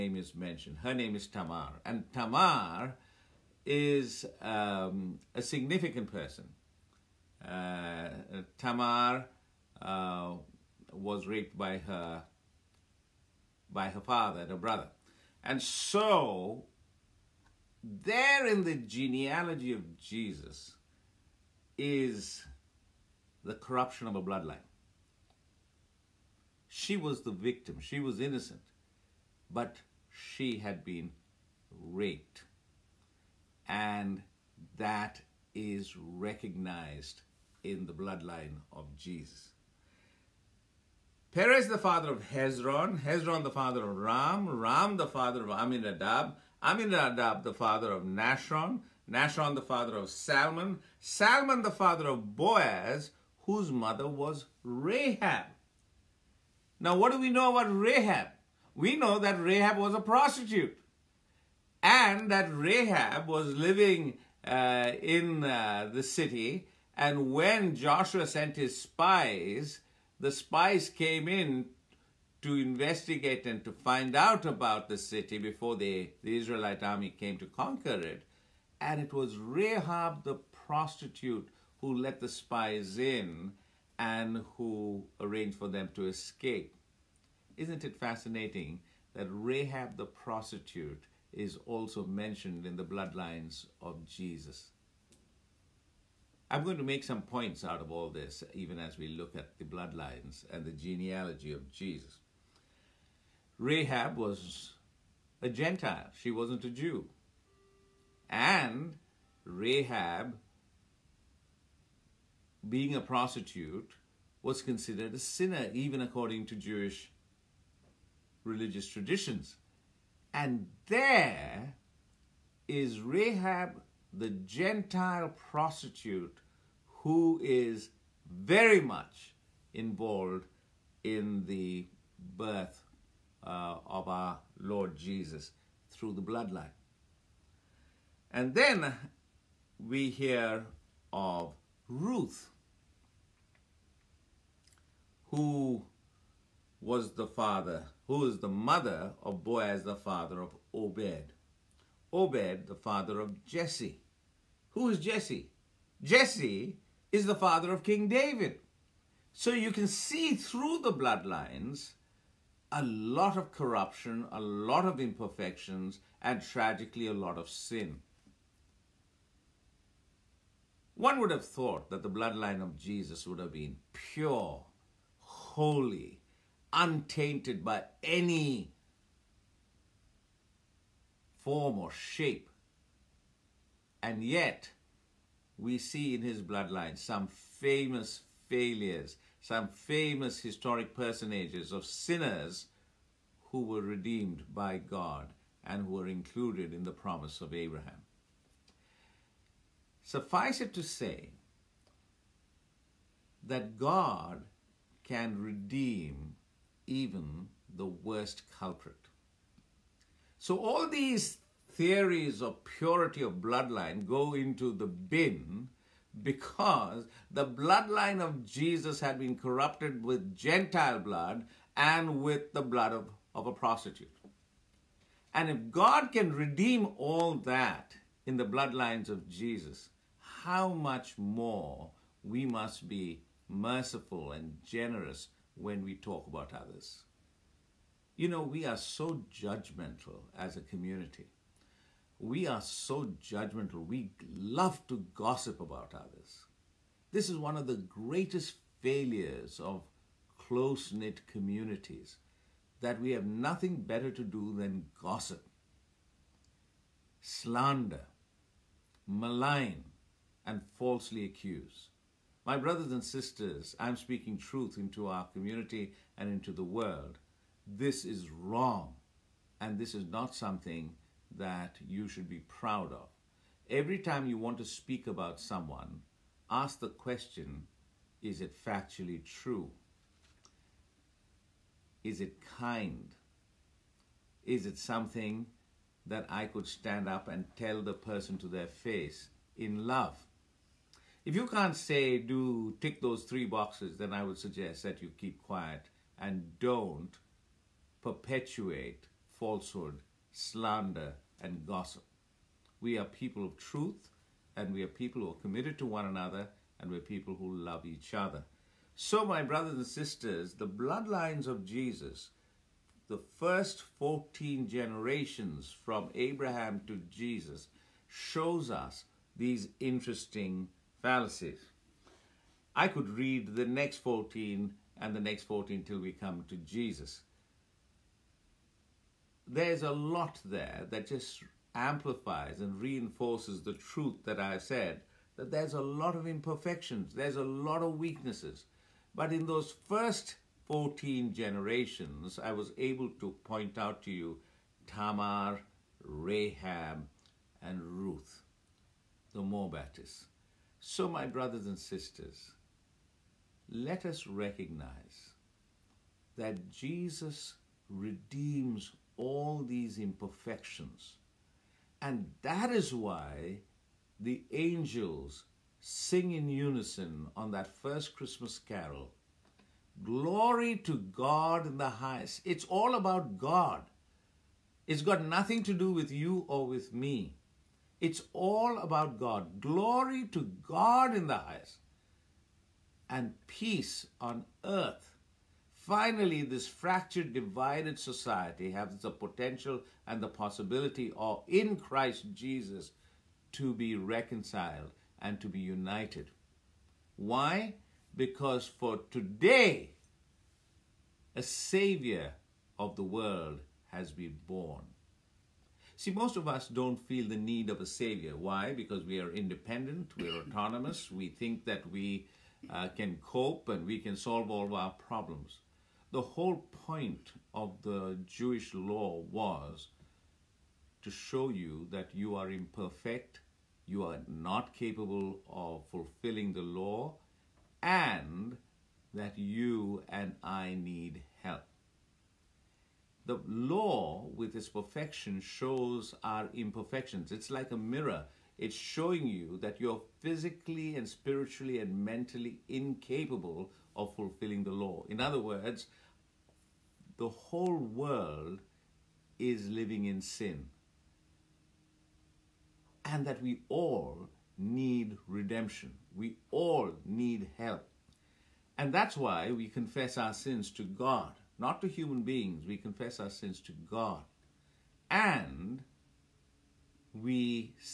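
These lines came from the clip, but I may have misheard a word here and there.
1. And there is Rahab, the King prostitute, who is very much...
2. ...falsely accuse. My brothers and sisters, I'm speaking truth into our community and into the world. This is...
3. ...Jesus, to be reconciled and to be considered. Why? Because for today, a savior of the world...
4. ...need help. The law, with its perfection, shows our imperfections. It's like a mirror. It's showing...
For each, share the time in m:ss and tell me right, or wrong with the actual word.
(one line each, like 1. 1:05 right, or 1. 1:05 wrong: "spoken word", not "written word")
1. 2:00 wrong: "Gentile", not "King"
2. 4:20 right
3. 6:32 wrong: "united", not "considered"
4. 7:10 right.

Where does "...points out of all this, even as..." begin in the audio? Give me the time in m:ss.
1:37.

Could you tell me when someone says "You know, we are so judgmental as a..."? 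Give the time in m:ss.
3:58.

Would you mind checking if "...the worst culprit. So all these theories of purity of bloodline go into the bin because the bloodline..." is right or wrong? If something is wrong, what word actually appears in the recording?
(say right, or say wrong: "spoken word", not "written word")
right.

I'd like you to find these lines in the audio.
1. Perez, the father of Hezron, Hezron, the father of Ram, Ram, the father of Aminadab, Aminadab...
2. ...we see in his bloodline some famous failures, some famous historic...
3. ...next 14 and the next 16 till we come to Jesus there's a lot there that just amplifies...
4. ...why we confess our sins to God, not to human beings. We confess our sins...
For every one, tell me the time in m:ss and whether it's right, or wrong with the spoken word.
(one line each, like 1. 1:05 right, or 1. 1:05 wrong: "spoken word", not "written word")
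1. 0:41 right
2. 3:05 right
3. 5:23 wrong: "14", not "16"
4. 7:39 right.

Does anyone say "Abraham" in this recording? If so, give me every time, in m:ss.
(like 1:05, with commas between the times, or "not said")
3:17, 5:16.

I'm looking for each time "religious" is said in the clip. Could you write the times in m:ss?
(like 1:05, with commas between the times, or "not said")
1:58.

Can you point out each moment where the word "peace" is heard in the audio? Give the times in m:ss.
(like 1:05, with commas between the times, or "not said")
6:23.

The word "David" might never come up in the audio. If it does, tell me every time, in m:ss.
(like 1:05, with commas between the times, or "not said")
2:38.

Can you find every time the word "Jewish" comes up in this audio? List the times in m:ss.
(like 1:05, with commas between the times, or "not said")
1:56, 6:58.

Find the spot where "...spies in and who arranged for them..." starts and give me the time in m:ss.
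1:22.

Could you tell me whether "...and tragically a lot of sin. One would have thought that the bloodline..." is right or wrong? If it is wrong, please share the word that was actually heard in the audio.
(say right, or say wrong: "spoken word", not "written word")
right.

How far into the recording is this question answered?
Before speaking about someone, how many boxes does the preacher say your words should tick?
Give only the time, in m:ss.
4:53.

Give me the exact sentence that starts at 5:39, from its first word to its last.
But in those first 14 generations, I was able to point out to you Tamar, Rahab, and Ruth, the Moabites.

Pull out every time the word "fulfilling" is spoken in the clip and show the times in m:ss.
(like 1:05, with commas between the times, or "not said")
7:05, 7:24.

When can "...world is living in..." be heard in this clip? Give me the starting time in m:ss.
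7:27.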